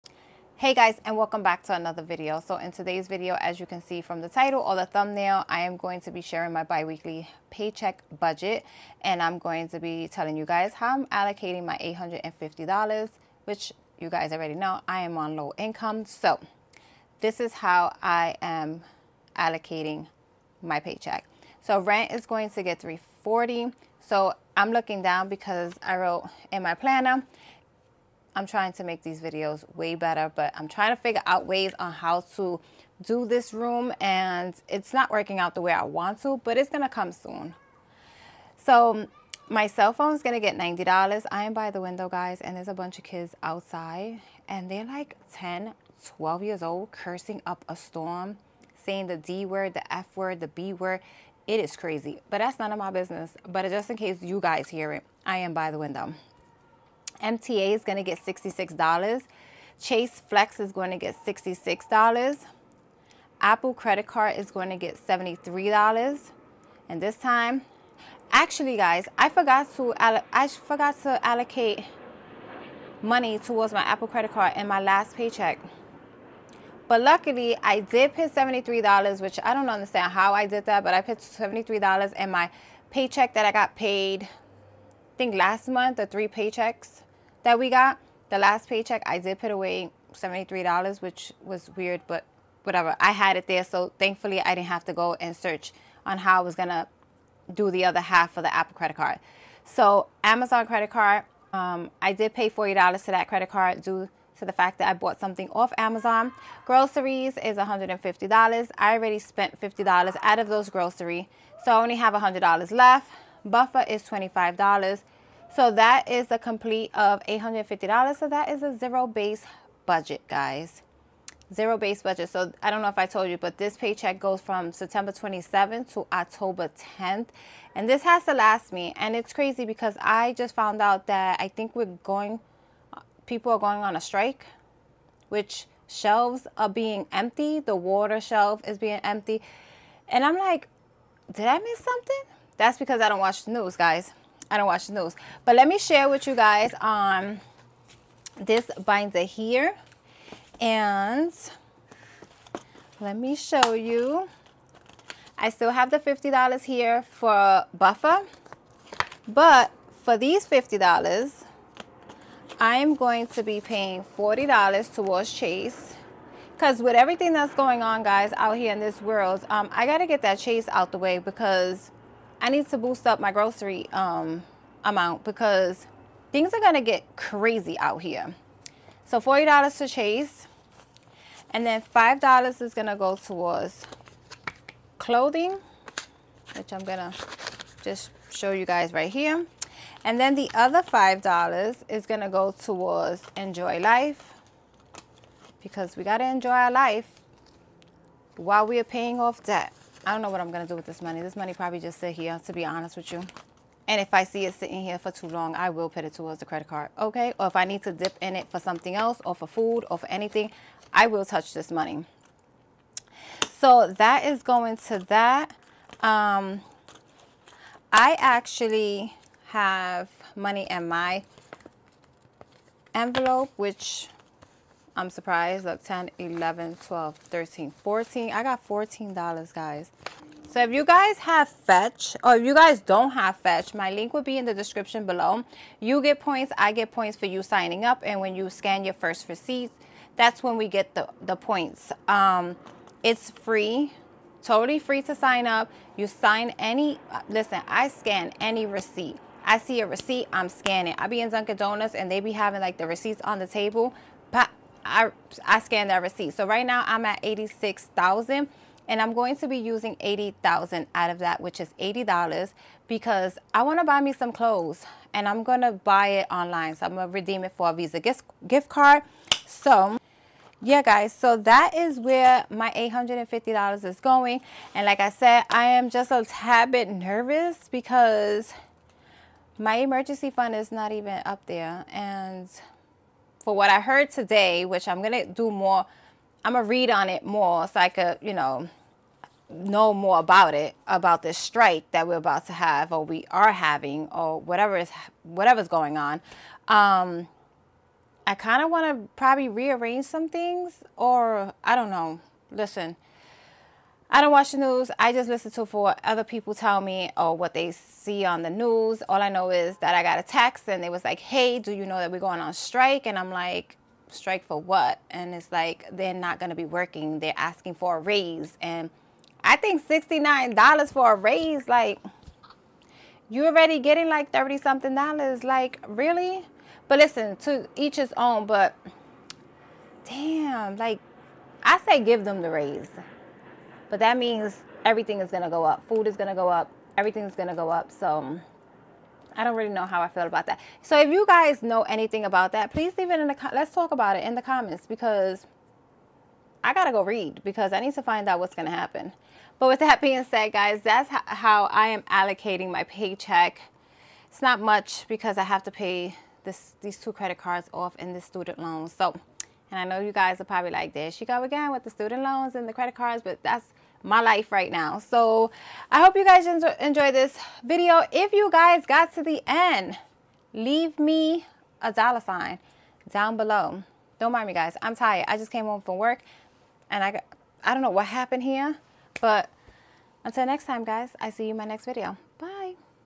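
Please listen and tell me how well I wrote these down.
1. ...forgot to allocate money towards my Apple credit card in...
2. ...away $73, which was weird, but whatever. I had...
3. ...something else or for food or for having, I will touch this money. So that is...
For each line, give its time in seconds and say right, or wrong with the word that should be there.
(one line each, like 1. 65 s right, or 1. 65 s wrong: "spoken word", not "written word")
1. 70 s right
2. 89 s right
3. 208 s wrong: "anything", not "having".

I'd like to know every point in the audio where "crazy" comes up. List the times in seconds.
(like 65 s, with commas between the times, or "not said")
51 s, 129 s, 177 s.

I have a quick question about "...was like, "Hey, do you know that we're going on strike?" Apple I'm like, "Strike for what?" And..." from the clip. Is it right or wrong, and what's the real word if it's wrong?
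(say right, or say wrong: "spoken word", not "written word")
wrong: "And", not "Apple".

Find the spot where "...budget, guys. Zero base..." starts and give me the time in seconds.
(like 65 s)
119 s.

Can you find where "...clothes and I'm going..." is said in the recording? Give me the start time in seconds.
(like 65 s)
264 s.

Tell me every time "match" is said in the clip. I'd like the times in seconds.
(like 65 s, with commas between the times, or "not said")
not said.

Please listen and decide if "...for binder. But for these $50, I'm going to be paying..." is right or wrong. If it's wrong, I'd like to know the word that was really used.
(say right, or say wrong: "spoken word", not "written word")
wrong: "buffer", not "binder".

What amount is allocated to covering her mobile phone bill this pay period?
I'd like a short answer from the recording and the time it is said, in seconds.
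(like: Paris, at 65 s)
$90, at 40 s.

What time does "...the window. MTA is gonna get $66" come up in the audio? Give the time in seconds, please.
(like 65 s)
55 s.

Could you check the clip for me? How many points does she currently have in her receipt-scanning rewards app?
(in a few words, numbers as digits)
86,000.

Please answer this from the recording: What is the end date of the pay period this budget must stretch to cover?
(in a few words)
October 10th.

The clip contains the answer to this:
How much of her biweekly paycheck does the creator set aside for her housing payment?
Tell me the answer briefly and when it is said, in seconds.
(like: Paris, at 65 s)
$340, at 22 s.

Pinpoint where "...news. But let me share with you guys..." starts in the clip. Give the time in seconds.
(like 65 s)
144 s.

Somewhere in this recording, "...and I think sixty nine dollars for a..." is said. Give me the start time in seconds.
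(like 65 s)
318 s.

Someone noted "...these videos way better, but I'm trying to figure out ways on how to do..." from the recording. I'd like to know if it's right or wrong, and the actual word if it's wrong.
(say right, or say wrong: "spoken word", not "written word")
right.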